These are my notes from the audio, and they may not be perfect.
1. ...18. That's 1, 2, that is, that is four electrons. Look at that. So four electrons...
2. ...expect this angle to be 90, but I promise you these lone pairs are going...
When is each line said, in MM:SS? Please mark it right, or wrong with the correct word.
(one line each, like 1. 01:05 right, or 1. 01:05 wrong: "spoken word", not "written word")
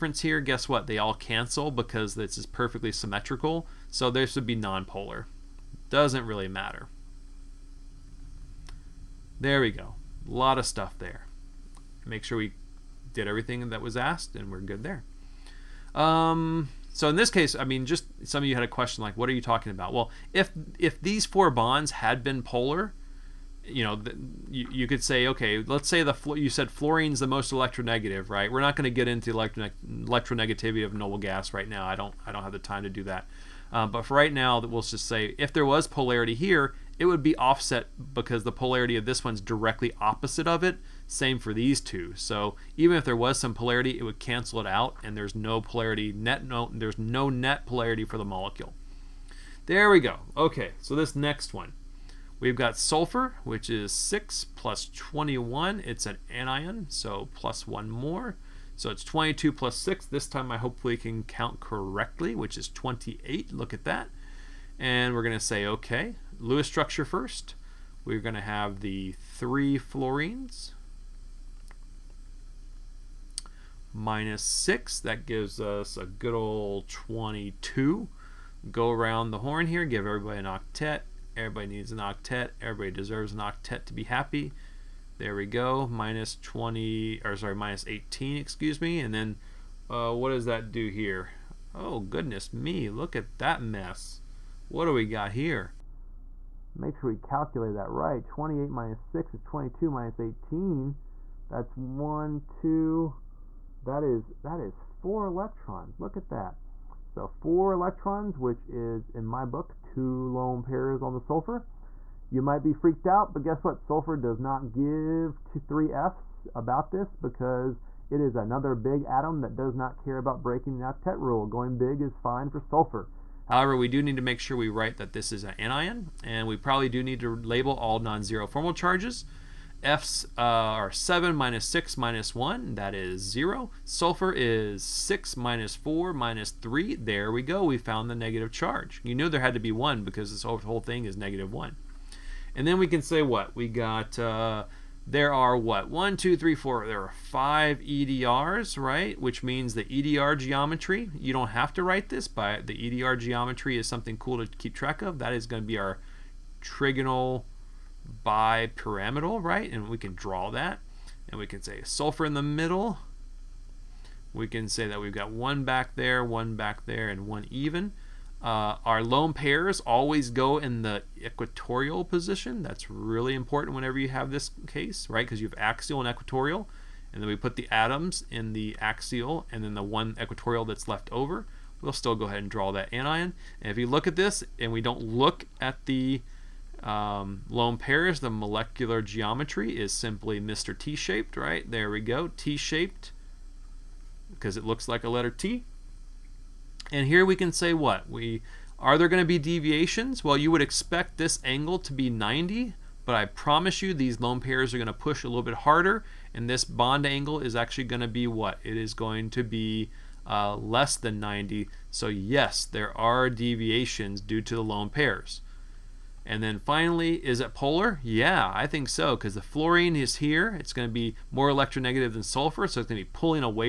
1. 01:40 right
2. 03:20 right.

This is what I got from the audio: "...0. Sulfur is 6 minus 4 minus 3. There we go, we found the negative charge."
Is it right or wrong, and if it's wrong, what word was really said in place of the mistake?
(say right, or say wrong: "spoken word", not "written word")
right.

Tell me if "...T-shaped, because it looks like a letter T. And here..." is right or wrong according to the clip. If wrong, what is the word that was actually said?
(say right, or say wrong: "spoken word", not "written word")
right.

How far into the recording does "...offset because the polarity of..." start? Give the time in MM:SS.
00:37.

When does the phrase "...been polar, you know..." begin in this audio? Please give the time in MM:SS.
00:22.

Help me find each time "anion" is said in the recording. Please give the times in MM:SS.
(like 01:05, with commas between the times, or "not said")
00:56, 02:05, 03:02.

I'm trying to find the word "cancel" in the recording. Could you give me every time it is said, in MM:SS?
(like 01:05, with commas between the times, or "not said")
00:01, 00:44.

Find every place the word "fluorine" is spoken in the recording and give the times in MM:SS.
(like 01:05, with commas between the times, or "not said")
00:26, 01:09, 03:39.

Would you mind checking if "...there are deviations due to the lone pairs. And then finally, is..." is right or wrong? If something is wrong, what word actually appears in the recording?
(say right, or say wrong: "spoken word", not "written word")
right.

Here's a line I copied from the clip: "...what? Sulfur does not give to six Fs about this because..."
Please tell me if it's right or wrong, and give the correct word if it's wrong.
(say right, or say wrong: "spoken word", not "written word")
wrong: "three", not "six".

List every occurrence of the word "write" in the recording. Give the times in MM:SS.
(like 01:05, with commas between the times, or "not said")
02:04, 02:31.